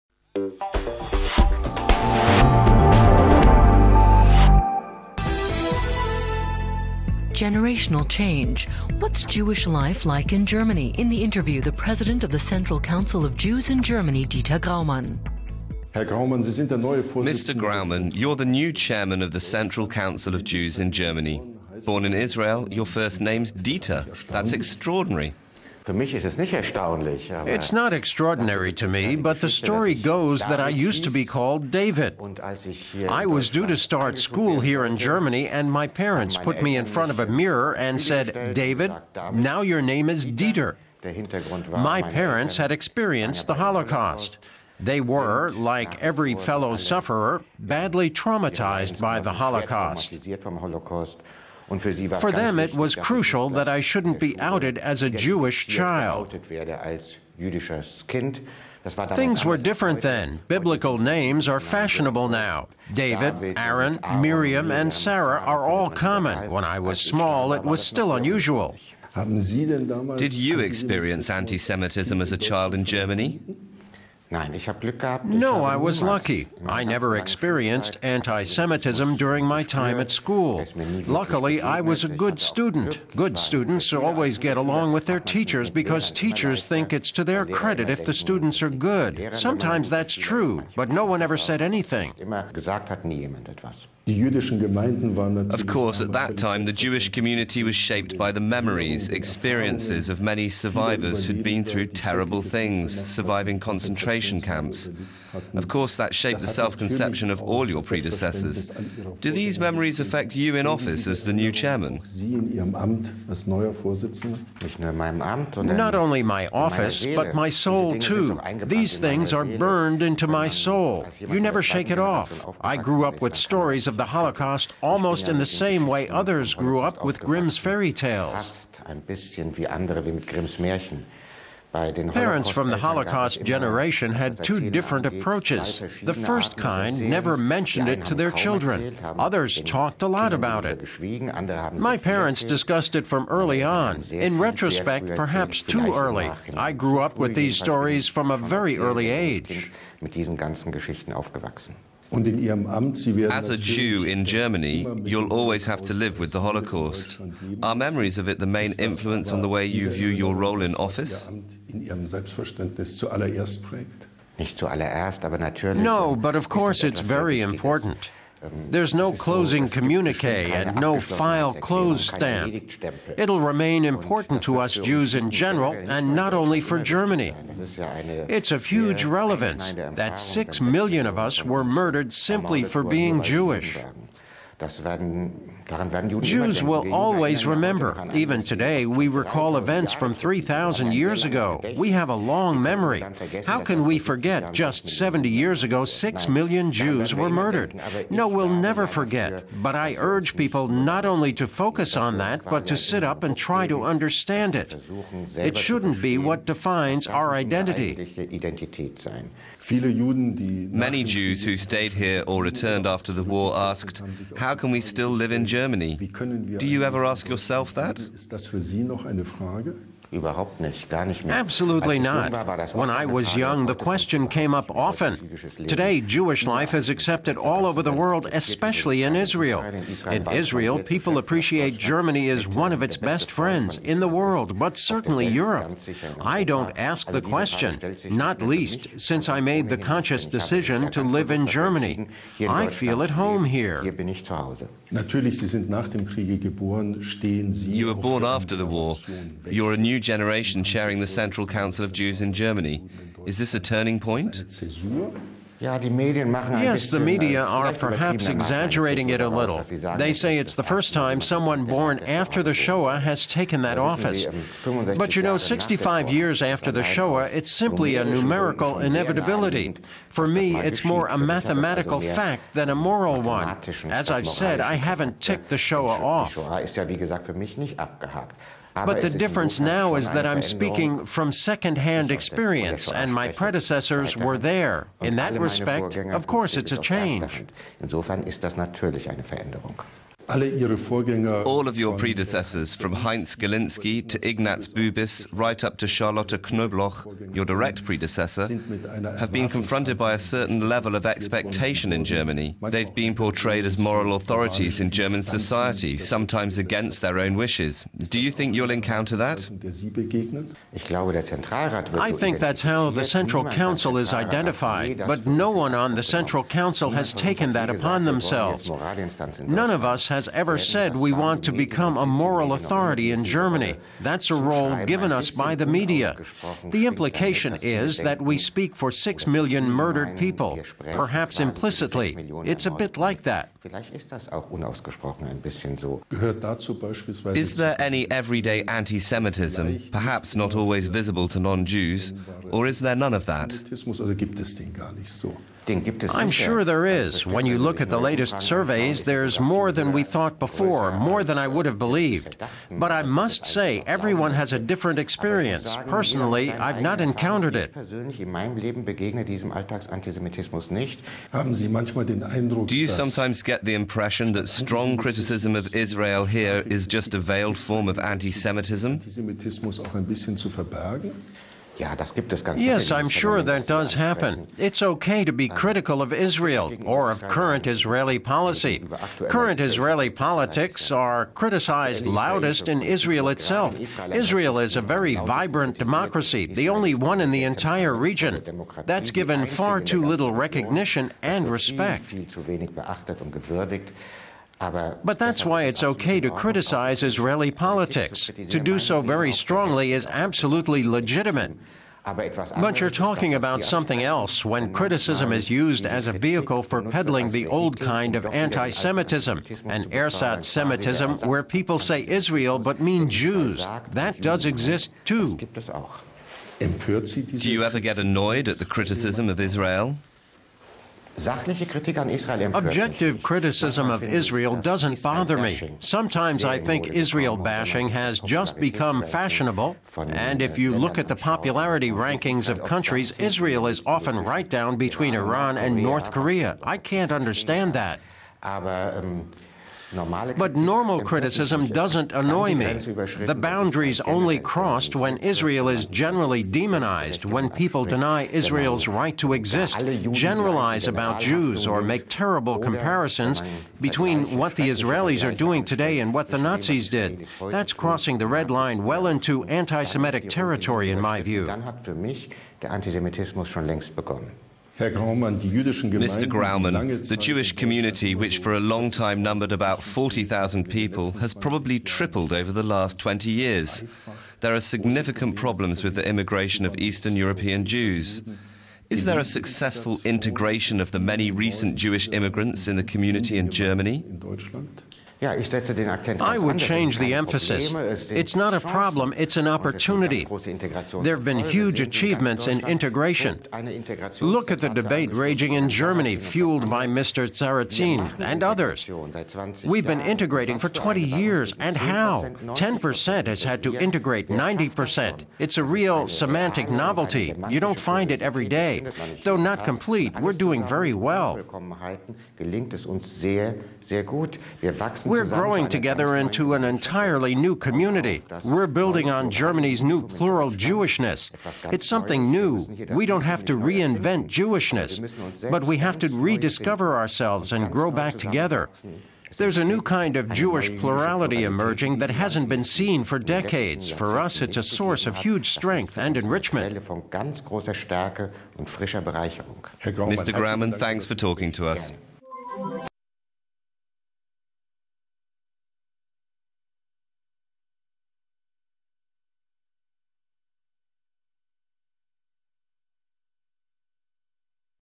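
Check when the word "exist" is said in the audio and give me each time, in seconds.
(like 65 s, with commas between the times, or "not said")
414 s, 449 s.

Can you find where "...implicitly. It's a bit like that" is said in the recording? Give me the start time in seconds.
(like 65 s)
331 s.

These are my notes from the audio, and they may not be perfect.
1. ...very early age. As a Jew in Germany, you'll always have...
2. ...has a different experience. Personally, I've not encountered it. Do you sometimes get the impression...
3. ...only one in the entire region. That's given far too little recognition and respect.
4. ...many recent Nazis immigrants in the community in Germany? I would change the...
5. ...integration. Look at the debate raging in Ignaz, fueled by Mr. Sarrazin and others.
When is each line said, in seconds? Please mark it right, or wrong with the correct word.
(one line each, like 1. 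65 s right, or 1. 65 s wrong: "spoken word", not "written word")
1. 148 s right
2. 354 s right
3. 386 s right
4. 480 s wrong: "Jewish", not "Nazis"
5. 492 s wrong: "Germany", not "Ignaz".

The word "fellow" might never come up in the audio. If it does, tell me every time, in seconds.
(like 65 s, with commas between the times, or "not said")
46 s.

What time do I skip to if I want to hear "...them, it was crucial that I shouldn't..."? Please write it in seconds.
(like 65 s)
52 s.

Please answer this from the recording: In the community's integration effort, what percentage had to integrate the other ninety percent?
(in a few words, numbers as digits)
10%.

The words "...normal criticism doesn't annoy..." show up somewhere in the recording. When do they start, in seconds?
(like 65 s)
440 s.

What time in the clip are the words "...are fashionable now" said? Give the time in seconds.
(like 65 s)
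61 s.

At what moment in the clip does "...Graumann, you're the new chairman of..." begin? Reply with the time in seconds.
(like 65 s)
17 s.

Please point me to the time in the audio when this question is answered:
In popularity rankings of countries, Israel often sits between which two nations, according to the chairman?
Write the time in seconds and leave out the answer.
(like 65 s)
435 s.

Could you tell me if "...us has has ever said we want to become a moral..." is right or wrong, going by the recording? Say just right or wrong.
right.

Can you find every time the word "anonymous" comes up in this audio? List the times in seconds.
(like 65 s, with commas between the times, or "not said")
not said.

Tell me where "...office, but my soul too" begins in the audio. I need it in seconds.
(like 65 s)
116 s.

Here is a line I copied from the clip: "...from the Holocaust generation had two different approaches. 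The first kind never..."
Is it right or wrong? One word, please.
right.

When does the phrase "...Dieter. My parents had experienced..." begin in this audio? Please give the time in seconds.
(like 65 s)
40 s.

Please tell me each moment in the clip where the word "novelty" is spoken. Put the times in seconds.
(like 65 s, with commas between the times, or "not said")
506 s.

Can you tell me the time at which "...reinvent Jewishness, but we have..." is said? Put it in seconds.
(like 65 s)
523 s.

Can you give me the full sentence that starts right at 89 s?
Sometimes that's true, but no one ever said anything.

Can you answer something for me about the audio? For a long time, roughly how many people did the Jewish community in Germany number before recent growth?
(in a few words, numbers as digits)
40,000.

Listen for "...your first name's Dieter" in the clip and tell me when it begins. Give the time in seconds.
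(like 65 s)
22 s.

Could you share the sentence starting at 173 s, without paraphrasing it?
It'll remain important to us Jews in general and not only for Germany.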